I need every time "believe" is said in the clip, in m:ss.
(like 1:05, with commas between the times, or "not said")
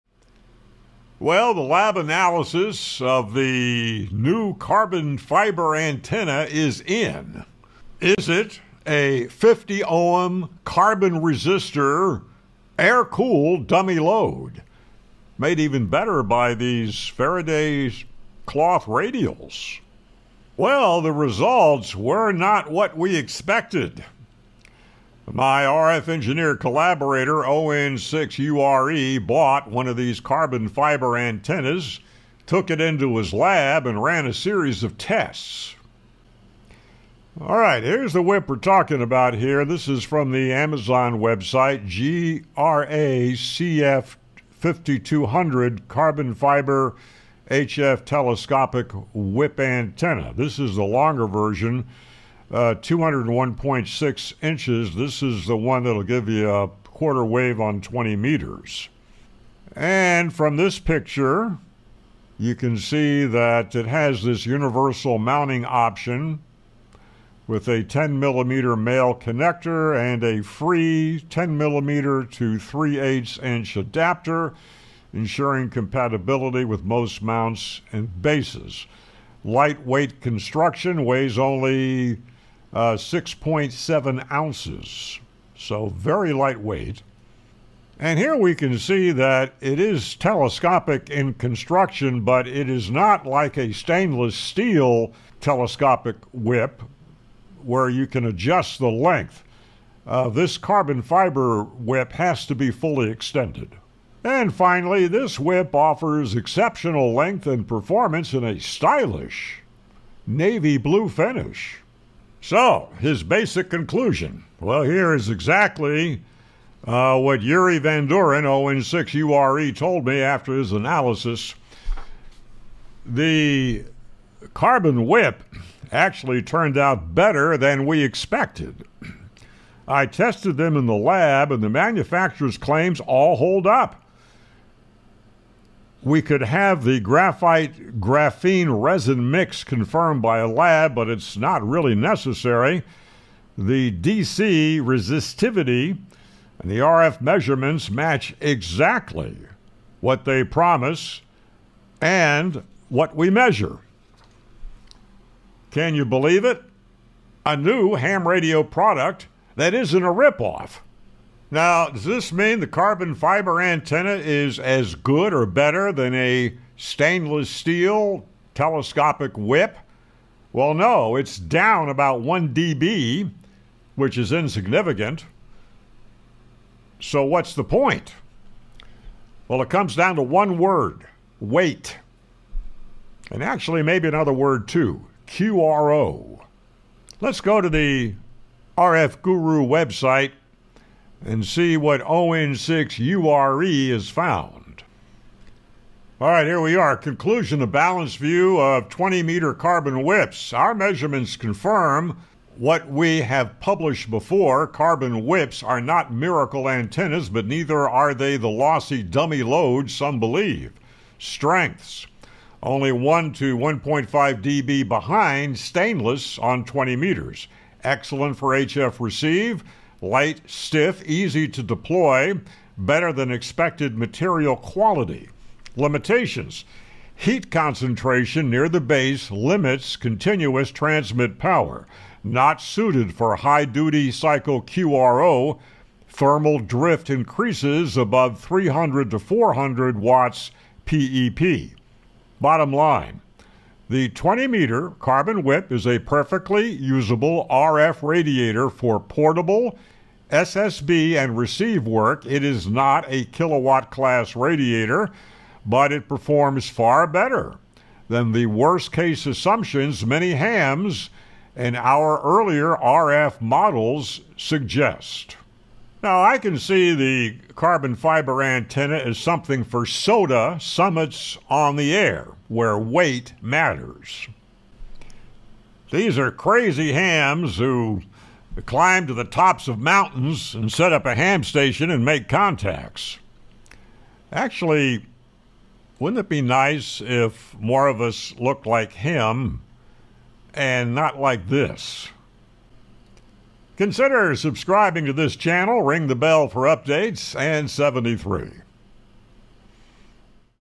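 2:36, 3:30.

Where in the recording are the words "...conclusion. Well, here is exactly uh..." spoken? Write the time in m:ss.
1:53.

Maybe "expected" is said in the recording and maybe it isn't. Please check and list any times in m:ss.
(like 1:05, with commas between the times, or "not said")
0:23, 2:08, 3:43.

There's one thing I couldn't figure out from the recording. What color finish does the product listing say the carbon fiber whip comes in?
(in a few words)
Navy blue.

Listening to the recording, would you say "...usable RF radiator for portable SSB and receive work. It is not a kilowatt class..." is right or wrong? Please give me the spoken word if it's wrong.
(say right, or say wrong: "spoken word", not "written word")
right.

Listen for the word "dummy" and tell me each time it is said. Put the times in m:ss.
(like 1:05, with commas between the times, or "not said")
0:13, 3:29.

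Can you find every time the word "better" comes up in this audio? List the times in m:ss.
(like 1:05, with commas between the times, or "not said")
0:15, 2:07, 2:45, 3:42, 4:17.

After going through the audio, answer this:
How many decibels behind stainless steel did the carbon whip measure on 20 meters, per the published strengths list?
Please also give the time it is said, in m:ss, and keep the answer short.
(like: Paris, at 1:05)
1 to 1.5 dB, at 3:32.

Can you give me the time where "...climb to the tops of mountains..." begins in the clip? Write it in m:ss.
4:38.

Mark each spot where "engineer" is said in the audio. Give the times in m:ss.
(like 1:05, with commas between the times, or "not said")
0:26.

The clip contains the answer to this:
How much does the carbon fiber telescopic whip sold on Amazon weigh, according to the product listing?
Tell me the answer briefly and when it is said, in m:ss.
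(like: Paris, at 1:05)
6.7 ounces, at 1:22.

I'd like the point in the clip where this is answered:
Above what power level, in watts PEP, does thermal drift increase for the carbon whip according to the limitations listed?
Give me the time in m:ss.
3:58.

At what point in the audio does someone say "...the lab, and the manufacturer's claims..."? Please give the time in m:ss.
2:10.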